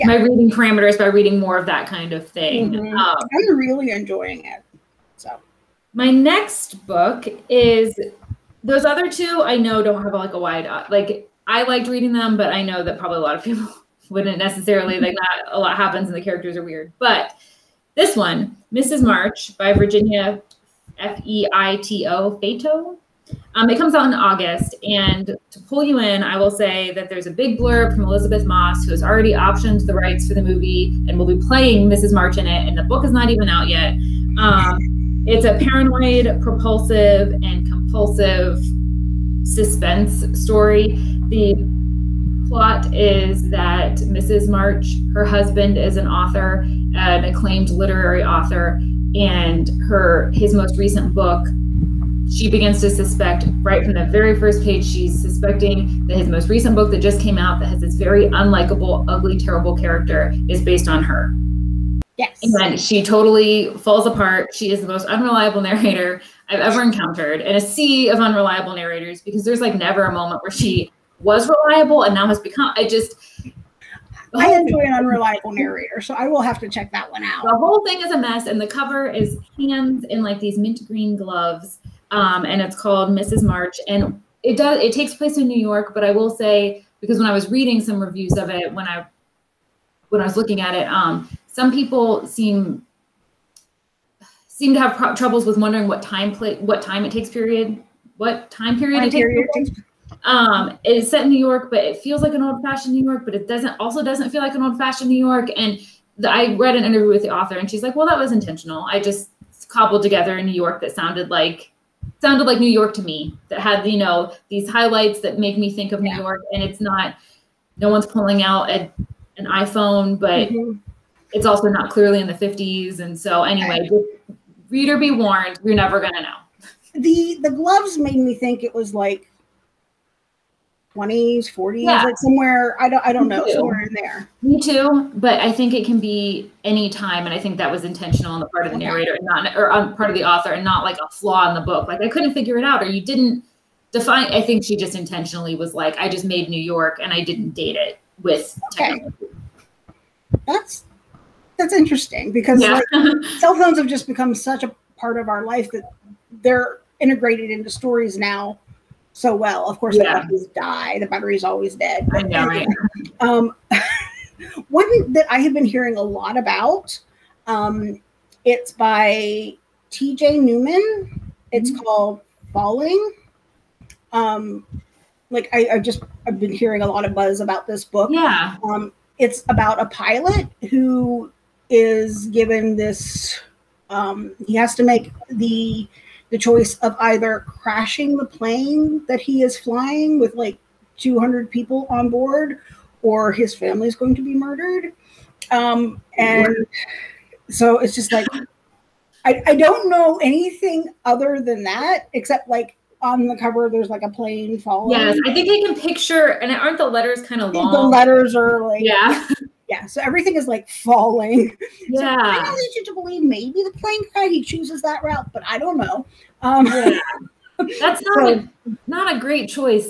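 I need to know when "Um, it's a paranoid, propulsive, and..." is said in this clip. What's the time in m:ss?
0:34.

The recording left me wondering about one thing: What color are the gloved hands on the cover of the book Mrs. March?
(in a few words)
Mint green.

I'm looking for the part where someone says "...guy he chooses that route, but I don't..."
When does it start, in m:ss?
3:34.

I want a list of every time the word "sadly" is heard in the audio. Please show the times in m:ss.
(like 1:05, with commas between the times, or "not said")
not said.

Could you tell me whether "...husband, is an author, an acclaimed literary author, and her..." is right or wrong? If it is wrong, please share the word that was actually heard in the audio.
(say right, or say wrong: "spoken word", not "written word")
right.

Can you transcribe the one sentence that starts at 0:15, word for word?
A lot happens and the characters are weird.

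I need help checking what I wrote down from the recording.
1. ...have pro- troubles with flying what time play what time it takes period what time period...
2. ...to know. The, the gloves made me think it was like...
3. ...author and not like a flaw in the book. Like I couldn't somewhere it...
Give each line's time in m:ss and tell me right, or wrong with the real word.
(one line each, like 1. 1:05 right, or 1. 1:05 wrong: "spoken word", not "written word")
1. 1:34 wrong: "wondering", not "flying"
2. 2:06 right
3. 2:20 wrong: "figure", not "somewhere".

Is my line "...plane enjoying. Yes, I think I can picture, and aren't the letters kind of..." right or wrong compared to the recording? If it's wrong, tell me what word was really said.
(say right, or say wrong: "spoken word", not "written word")
wrong: "falling", not "enjoying".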